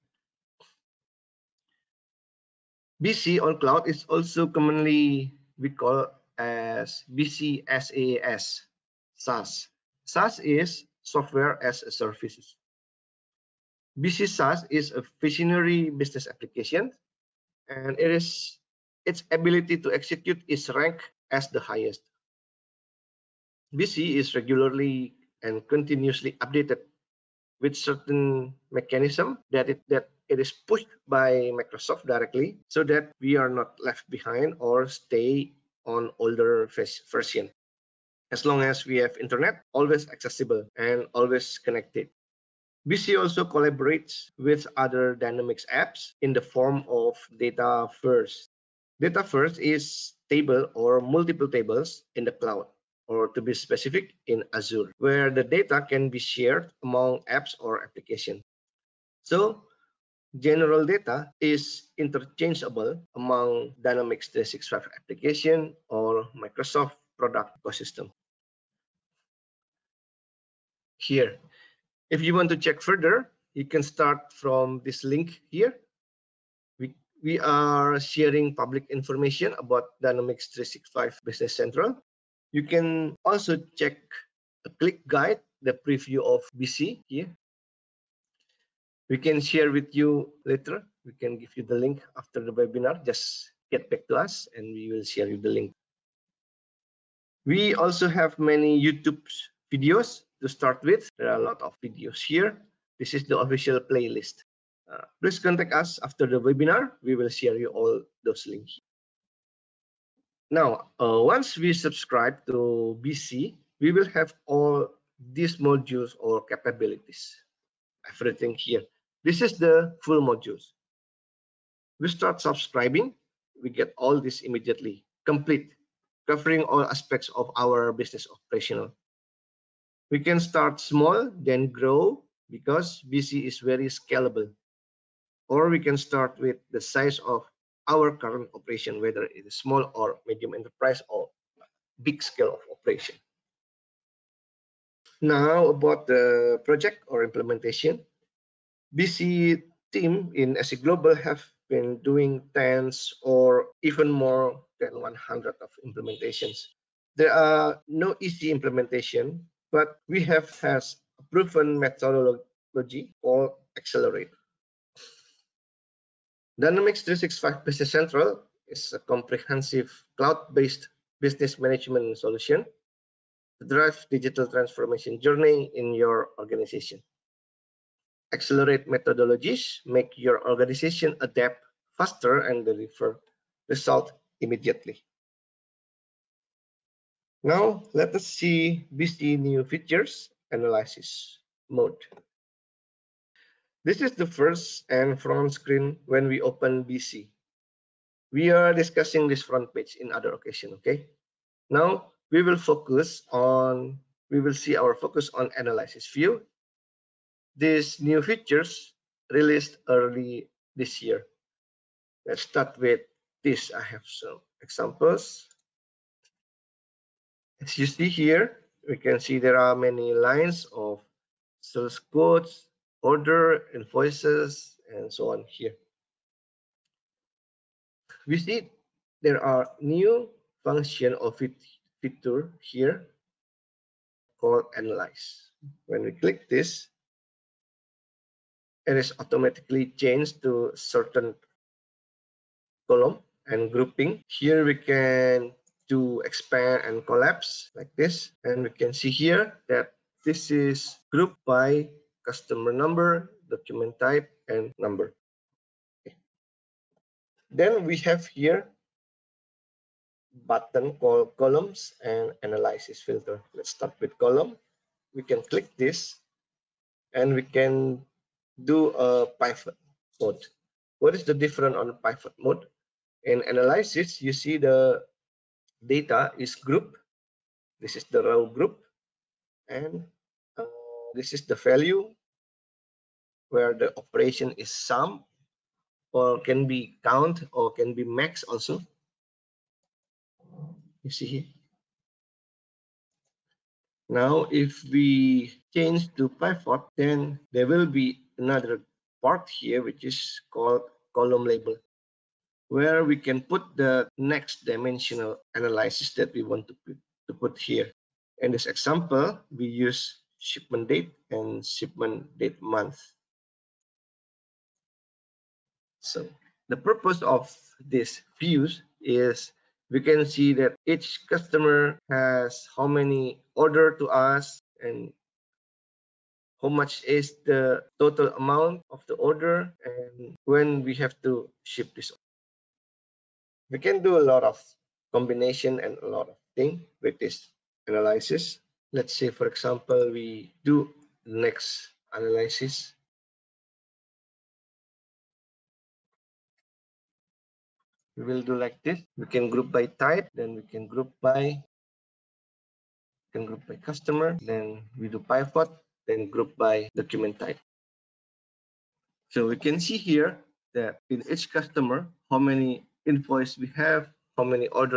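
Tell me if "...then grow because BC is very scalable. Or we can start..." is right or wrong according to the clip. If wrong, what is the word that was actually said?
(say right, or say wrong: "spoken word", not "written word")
right.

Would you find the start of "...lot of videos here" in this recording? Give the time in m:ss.
1:41.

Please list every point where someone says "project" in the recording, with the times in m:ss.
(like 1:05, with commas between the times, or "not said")
2:26.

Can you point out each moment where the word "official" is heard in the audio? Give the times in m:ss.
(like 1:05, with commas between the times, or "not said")
1:43.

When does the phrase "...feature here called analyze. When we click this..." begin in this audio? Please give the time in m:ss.
3:52.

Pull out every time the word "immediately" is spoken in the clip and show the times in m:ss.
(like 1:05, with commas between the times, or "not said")
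2:04, 3:04.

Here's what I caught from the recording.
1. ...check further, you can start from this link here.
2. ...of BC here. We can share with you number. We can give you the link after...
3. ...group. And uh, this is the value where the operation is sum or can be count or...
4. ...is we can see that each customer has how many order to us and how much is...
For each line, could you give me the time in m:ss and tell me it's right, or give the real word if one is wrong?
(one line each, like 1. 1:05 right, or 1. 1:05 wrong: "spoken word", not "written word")
1. 1:12 right
2. 1:26 wrong: "later", not "number"
3. 4:38 right
4. 5:19 right.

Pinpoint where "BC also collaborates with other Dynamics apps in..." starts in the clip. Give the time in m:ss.
0:42.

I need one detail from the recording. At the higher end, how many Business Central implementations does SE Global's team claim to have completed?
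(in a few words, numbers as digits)
more than 100.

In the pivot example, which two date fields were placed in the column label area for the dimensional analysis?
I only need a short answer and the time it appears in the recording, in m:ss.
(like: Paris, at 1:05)
shipment date and shipment date month, at 5:10.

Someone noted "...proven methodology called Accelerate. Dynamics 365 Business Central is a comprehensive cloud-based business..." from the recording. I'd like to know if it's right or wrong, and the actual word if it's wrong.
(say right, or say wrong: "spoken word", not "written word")
right.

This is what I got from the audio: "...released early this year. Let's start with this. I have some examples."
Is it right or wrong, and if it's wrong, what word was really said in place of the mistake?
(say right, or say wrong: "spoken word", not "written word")
right.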